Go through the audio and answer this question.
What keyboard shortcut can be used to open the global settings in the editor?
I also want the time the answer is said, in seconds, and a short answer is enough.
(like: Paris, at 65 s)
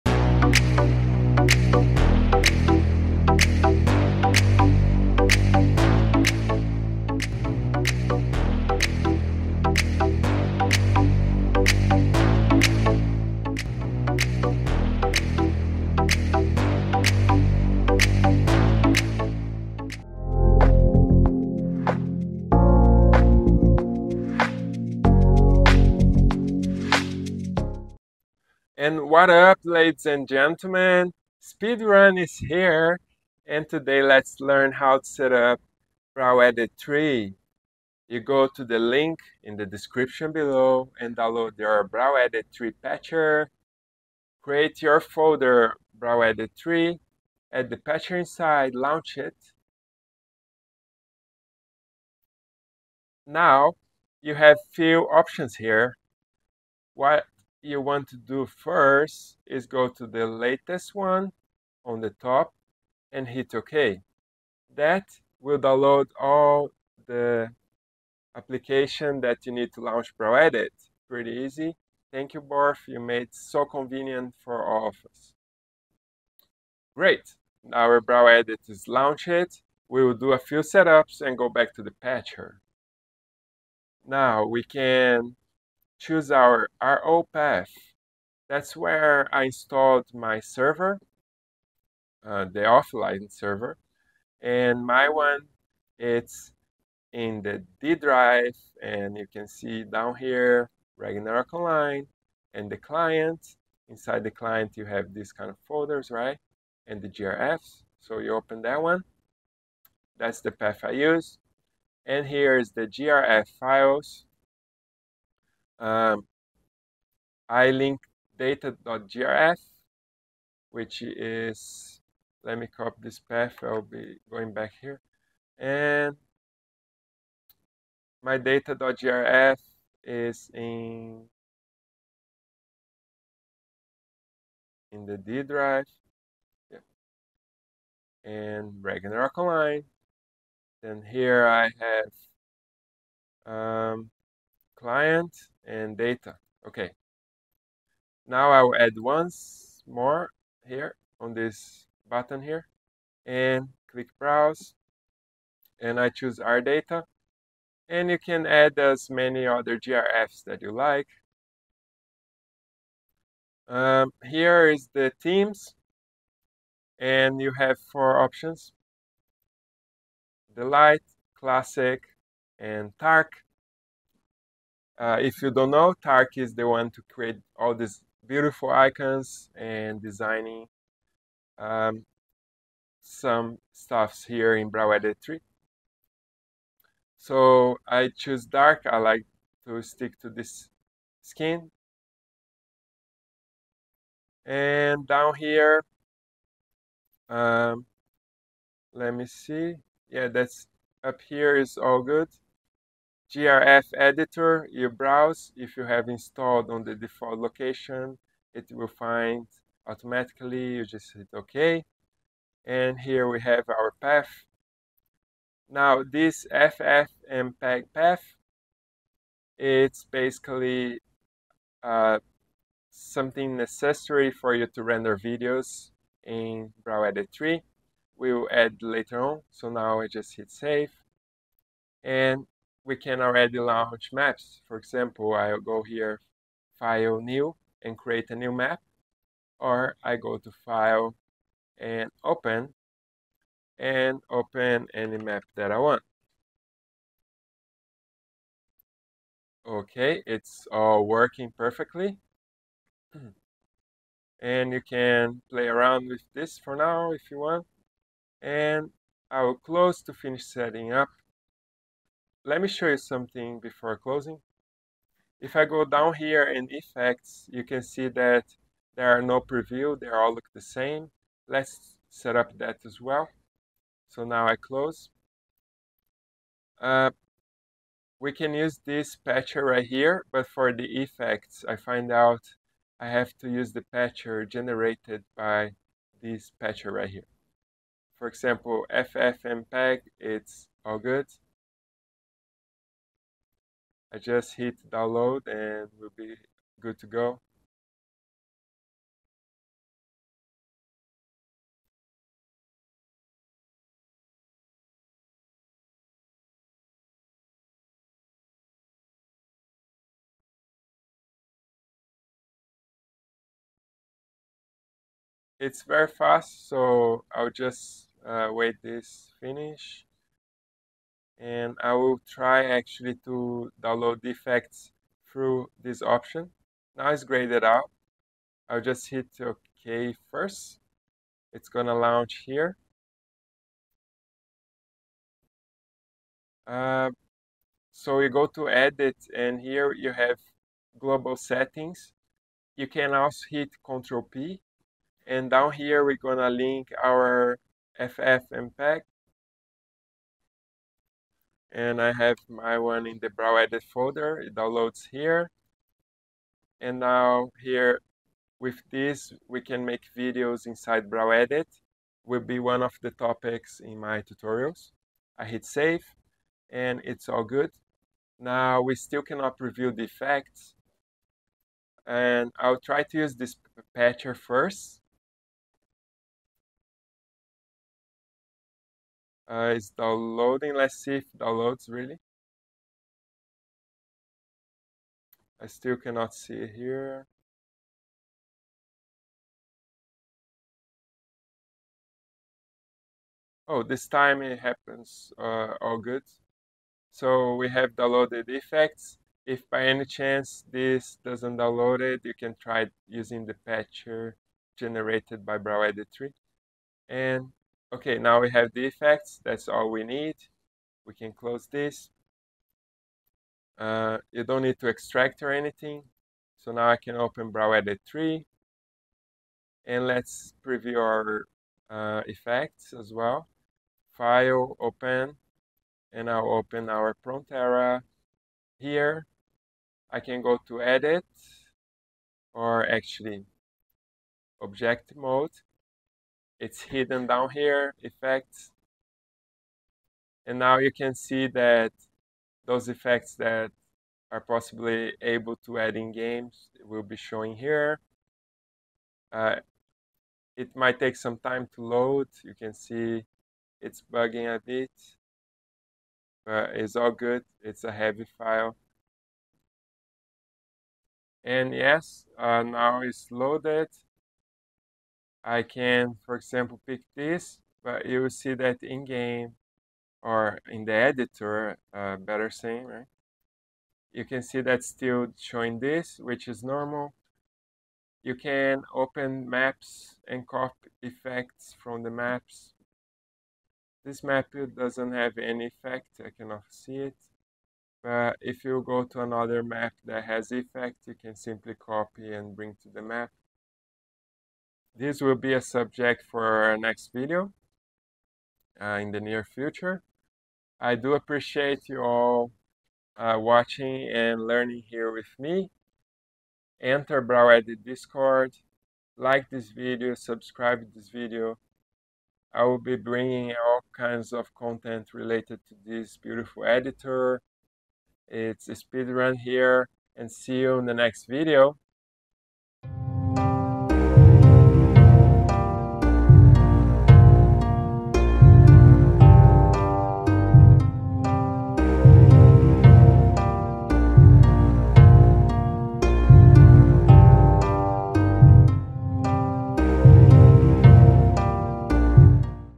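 Control P, at 343 s.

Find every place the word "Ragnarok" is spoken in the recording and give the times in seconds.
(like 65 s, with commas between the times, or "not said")
100 s, 138 s.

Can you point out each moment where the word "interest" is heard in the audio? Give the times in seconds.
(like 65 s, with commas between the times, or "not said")
not said.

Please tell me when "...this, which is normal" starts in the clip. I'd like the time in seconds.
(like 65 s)
475 s.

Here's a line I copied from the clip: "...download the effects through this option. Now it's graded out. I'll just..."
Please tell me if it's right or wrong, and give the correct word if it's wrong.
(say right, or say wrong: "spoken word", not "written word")
right.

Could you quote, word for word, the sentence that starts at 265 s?
If I go down here in effects, you can see that there are no preview, they all look the same.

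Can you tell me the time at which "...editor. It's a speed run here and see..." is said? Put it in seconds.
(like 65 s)
516 s.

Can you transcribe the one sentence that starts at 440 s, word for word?
And now you can see that those effects that are possibly able to add in games will be showing here.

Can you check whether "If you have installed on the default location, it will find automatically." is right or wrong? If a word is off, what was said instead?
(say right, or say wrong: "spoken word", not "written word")
right.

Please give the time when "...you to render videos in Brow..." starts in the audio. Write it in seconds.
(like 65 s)
224 s.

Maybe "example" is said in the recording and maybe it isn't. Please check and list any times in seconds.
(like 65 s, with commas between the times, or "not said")
234 s, 288 s, 466 s.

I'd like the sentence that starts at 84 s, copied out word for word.
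Now we can choose our RO path.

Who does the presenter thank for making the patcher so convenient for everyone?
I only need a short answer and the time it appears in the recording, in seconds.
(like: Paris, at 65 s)
Borf, at 72 s.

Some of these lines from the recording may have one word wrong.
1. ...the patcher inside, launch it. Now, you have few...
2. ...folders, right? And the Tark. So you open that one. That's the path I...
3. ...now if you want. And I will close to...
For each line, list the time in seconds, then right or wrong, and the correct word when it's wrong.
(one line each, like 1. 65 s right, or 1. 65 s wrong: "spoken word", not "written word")
1. 47 s right
2. 105 s wrong: "GRFs", not "Tark"
3. 256 s right.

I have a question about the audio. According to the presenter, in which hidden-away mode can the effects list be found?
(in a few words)
Object Mode.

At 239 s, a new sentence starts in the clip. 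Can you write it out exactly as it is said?
Or I go to File and Open, and open any map that I want.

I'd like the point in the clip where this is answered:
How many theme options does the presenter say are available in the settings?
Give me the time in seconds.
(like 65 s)
167 s.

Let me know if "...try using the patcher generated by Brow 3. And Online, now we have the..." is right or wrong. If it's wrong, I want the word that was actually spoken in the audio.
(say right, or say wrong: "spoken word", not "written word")
wrong: "Okay", not "Online".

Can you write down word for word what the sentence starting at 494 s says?
This will be a subject for our next video uh, in the near future.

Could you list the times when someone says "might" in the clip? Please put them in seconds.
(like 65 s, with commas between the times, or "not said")
450 s.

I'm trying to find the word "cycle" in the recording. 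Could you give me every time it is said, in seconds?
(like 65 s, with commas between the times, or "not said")
not said.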